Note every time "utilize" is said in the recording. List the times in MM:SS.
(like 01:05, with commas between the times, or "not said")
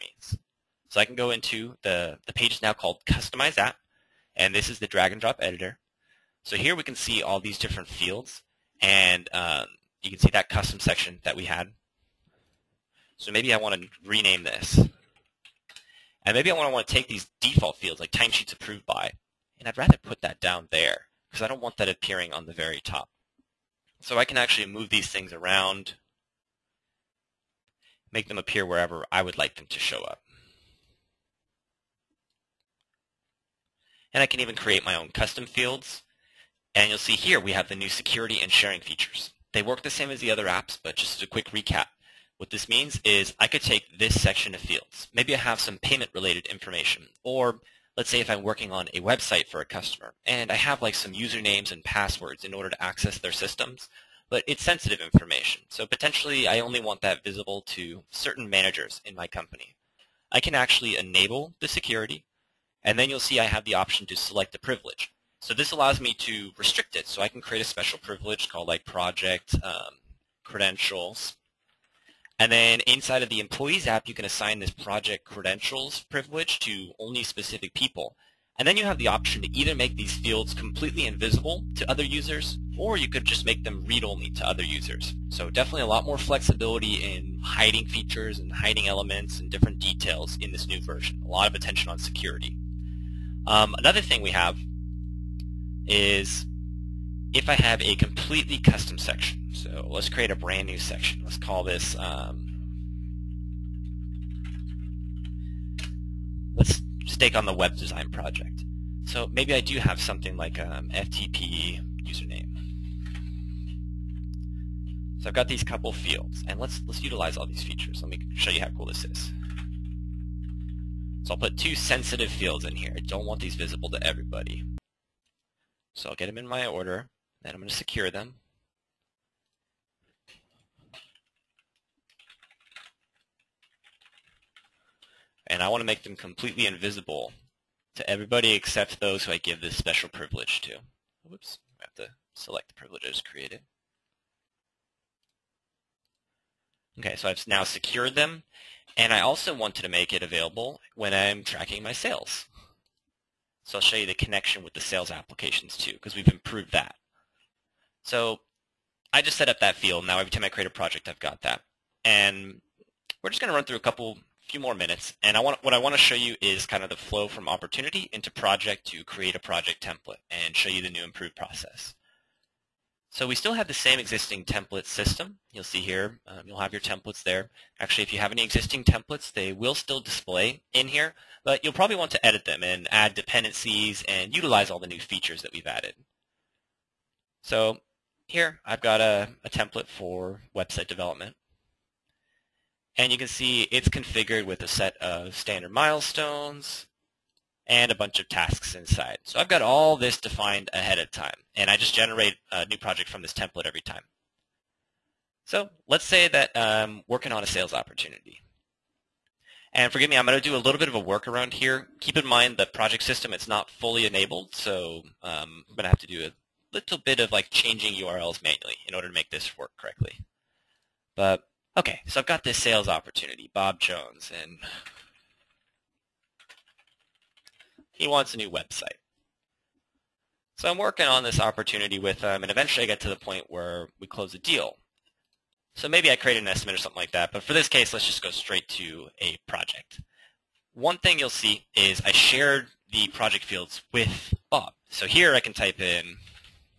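01:57, 03:04.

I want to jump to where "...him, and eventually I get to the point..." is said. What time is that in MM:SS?
03:52.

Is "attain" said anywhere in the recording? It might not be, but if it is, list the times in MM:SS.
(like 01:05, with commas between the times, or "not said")
not said.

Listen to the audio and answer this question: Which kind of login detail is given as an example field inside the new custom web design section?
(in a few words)
FTP username.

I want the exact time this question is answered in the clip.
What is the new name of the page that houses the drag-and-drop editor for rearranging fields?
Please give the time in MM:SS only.
00:03.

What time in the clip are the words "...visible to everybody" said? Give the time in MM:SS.
02:03.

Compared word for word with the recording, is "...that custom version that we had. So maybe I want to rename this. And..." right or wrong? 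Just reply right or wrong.
wrong.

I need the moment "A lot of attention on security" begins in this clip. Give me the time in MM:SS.
01:31.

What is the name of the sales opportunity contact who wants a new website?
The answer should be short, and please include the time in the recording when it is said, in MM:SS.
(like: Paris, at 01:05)
Bob Jones, at 03:43.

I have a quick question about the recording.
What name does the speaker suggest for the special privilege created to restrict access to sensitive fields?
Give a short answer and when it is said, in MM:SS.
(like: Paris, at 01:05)
project credentials, at 01:08.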